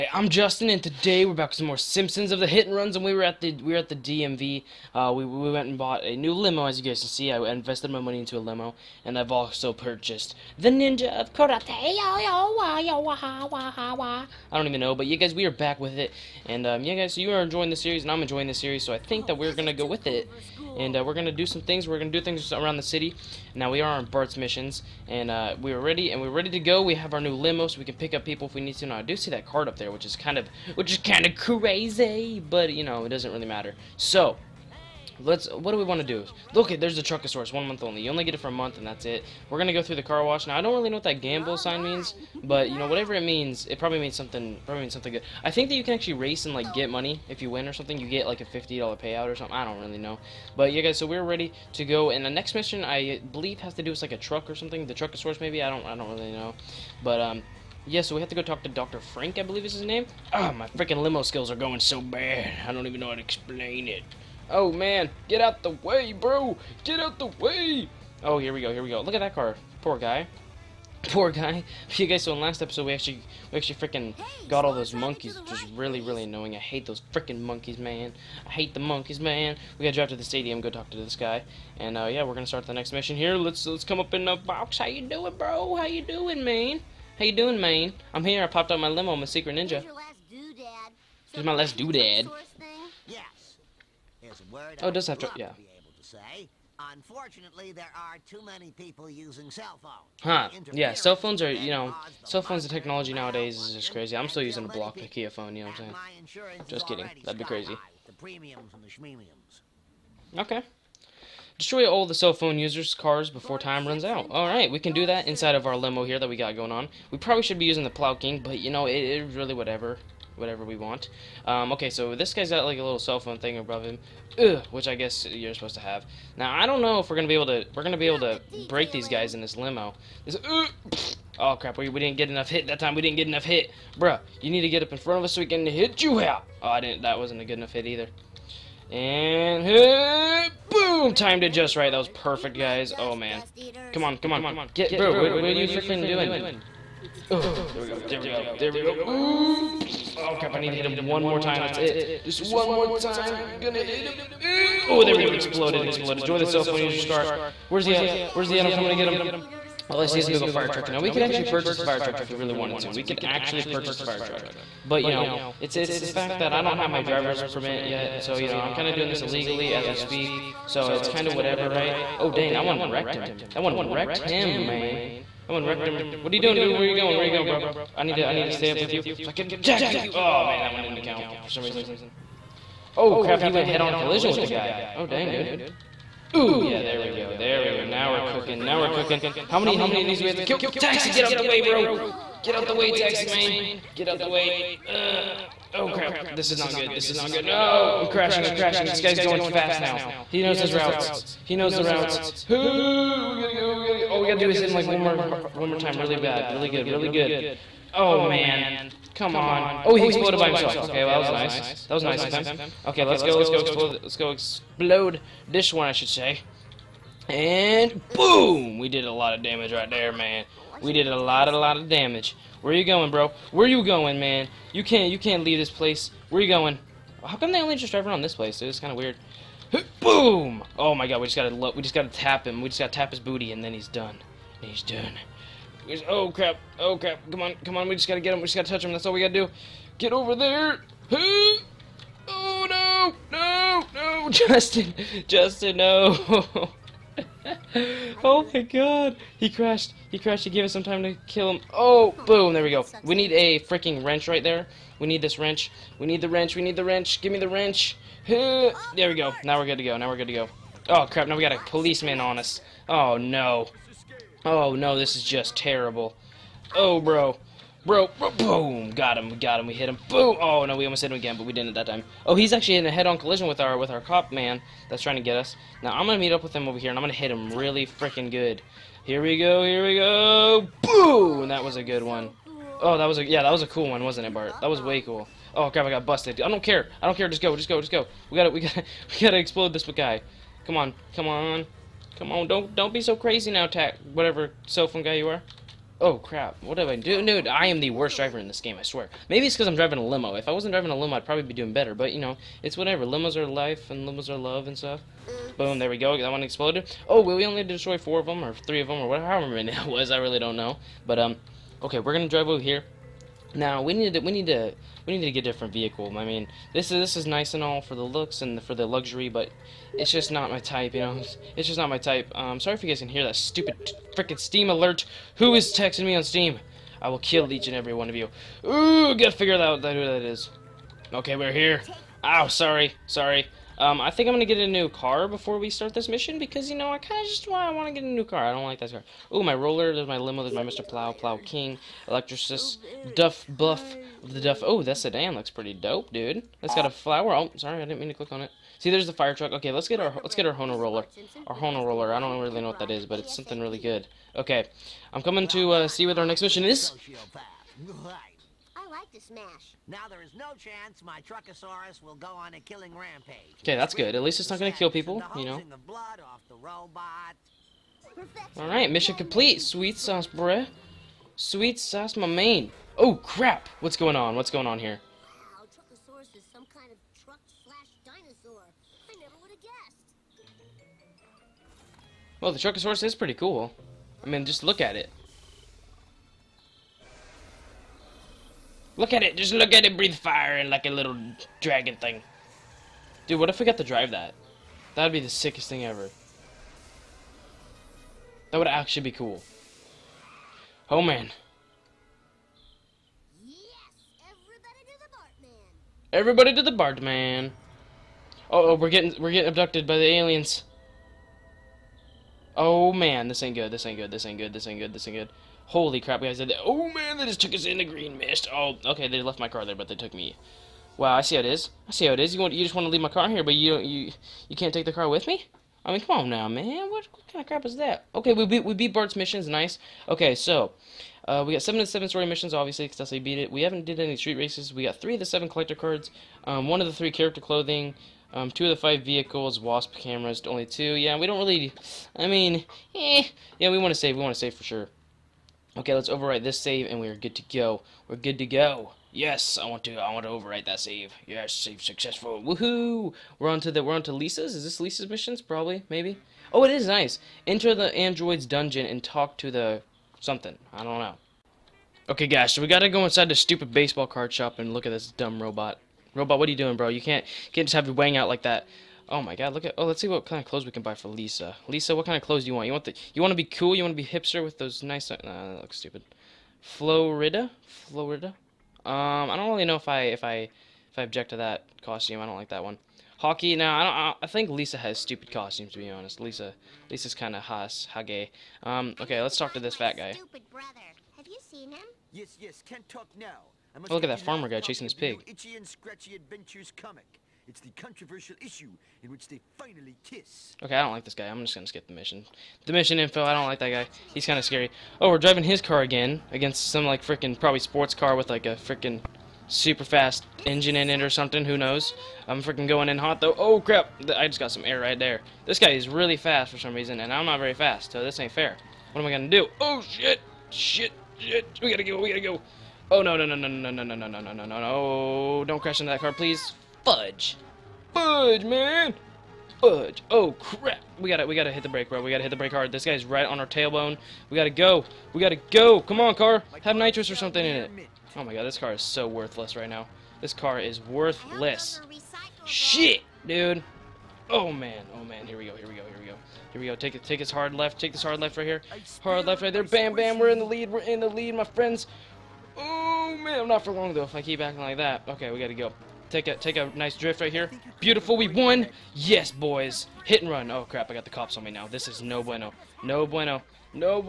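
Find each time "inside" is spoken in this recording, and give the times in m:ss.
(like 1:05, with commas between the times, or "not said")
1:55, 7:43.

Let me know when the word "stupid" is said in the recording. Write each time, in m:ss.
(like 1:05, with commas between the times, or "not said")
5:23, 7:43, 7:55, 8:04, 8:10.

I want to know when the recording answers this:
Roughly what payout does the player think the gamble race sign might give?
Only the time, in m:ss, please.
0:48.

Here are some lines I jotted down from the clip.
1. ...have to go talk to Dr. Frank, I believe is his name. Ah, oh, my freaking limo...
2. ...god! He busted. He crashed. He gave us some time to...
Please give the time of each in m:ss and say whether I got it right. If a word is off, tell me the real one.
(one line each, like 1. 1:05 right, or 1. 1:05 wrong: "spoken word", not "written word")
1. 0:58 right
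2. 4:08 wrong: "crashed", not "busted".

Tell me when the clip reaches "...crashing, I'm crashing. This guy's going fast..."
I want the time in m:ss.
3:18.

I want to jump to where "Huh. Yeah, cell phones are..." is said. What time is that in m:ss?
1:40.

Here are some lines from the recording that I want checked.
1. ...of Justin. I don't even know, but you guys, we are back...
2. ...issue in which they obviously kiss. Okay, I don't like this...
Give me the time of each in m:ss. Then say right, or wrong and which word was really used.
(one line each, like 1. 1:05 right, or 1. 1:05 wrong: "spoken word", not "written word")
1. 0:11 wrong: "Karate", not "Justin"
2. 8:18 wrong: "finally", not "obviously".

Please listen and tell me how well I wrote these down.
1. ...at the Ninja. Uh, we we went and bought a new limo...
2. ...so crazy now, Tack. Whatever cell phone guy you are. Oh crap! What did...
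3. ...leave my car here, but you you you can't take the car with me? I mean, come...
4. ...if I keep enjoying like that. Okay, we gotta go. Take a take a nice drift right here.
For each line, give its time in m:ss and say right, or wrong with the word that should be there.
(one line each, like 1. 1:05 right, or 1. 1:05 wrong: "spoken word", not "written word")
1. 0:03 wrong: "DMV", not "Ninja"
2. 4:53 right
3. 7:02 right
4. 9:14 wrong: "acting", not "enjoying".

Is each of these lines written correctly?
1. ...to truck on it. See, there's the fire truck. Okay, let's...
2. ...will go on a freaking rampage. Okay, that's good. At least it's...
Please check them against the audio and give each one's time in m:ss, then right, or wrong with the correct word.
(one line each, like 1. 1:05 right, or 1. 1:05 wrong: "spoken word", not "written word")
1. 5:48 wrong: "click", not "truck"
2. 6:02 wrong: "killing", not "freaking".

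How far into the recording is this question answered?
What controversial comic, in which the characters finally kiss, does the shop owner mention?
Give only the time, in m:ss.
8:15.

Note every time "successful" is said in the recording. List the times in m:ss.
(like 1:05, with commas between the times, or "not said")
7:31.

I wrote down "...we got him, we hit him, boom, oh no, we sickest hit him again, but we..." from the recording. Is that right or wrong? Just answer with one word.
wrong.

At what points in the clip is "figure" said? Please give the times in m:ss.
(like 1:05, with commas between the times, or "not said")
5:29.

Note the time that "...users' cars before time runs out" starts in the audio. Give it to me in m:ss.
1:52.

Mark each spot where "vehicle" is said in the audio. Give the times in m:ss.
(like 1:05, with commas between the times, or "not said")
5:15, 7:19.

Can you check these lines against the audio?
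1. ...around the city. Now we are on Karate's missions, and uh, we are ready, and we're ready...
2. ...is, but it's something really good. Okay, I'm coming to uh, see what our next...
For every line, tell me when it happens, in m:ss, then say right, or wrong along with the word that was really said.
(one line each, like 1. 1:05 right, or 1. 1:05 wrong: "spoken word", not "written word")
1. 0:22 wrong: "Bart", not "Karate"
2. 5:52 right.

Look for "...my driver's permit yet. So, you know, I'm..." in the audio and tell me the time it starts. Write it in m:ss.
2:46.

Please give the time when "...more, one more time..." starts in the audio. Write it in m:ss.
3:24.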